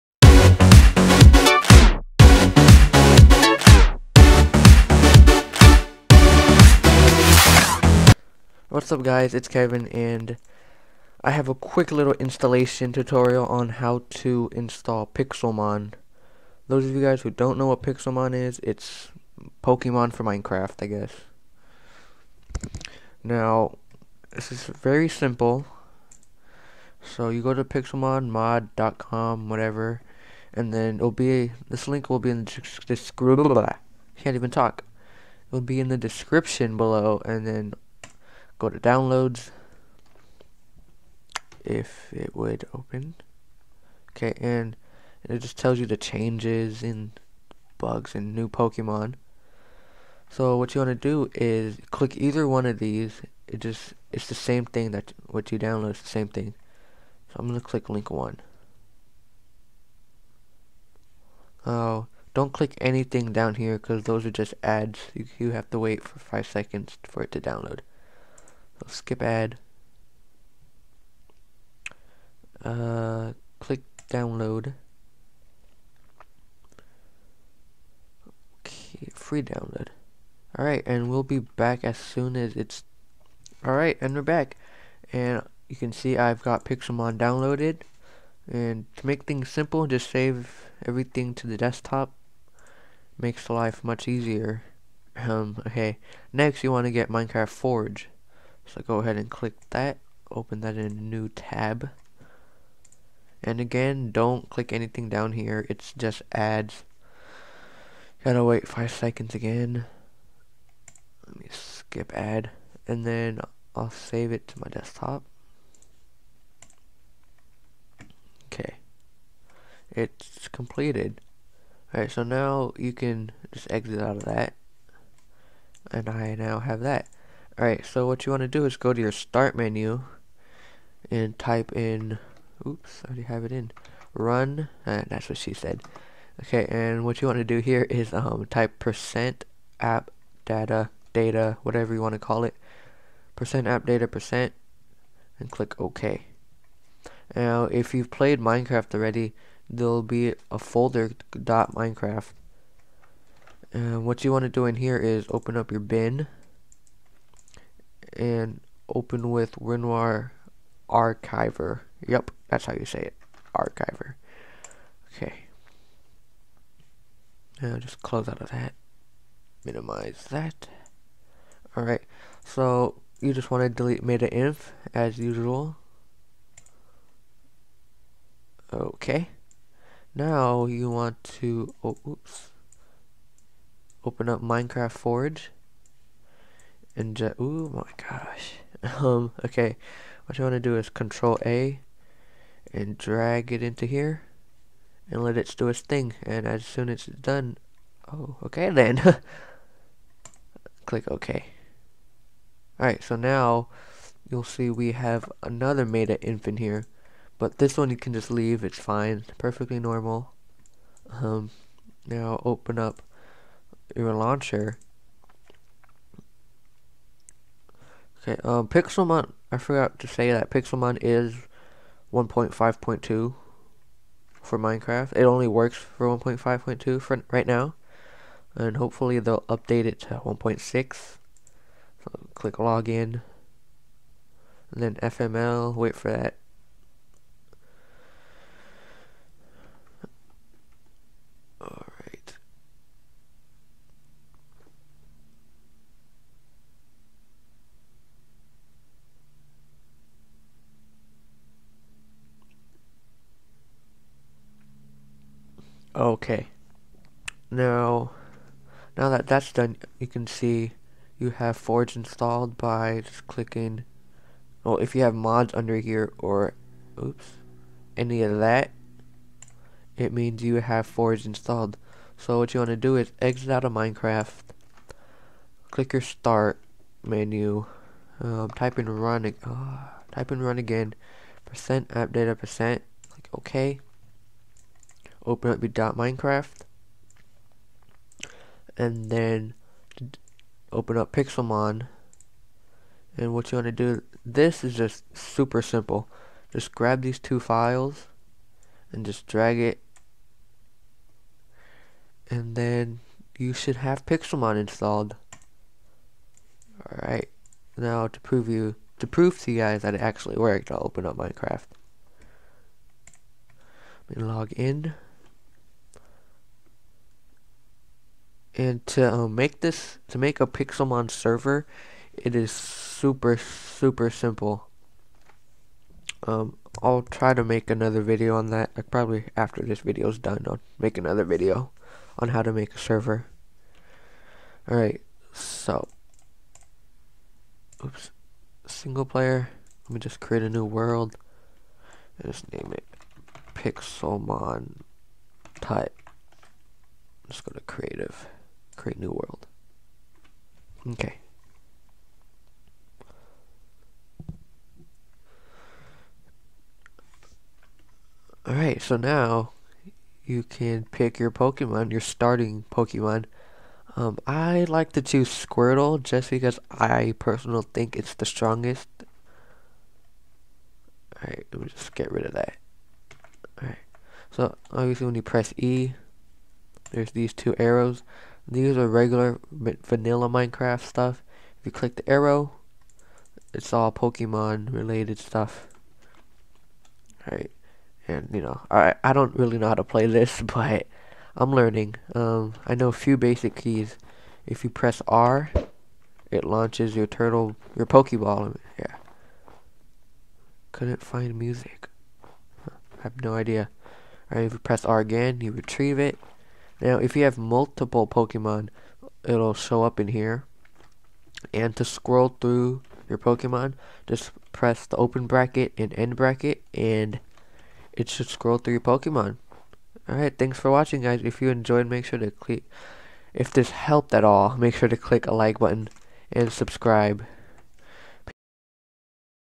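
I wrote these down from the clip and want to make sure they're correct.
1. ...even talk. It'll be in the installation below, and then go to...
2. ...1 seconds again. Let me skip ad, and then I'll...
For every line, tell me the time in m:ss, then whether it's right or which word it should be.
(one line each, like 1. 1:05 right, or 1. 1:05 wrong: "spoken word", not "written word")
1. 0:34 wrong: "description", not "installation"
2. 1:48 wrong: "5", not "1".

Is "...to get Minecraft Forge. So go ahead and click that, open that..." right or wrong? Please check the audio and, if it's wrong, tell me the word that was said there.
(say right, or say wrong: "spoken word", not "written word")
right.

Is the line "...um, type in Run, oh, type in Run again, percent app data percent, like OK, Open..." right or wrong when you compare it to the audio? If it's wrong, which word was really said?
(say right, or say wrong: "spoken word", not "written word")
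right.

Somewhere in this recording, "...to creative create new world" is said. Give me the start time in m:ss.
5:47.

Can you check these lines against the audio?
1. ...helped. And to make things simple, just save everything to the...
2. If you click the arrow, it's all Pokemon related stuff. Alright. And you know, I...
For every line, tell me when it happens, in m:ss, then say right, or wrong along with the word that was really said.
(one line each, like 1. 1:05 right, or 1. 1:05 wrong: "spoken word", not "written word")
1. 1:27 wrong: "downloaded", not "helped"
2. 6:21 right.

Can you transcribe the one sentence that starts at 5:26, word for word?
Um, I'll try to make another video on that.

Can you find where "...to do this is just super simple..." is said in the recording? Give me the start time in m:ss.
4:53.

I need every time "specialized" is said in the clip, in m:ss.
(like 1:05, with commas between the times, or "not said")
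not said.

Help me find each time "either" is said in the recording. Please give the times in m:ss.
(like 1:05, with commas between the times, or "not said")
0:52.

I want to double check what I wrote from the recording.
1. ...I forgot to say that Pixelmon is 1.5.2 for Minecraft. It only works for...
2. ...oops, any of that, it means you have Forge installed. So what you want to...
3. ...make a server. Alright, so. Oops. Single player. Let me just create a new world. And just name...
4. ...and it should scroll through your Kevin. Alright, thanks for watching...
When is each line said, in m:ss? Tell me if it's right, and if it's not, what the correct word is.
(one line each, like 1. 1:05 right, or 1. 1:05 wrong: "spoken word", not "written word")
1. 3:39 right
2. 4:27 right
3. 5:32 right
4. 6:56 wrong: "Pokemon", not "Kevin".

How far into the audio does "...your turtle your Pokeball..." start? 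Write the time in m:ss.
6:36.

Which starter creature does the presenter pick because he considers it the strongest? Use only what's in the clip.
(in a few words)
Squirtle.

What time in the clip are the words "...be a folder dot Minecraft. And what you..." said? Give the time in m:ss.
2:30.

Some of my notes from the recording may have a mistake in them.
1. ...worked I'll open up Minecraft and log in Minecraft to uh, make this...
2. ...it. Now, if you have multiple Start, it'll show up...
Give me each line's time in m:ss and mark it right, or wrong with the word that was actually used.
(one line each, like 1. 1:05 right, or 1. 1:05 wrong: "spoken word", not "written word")
1. 5:10 wrong: "And", not "Minecraft"
2. 6:45 wrong: "Pokemon", not "Start".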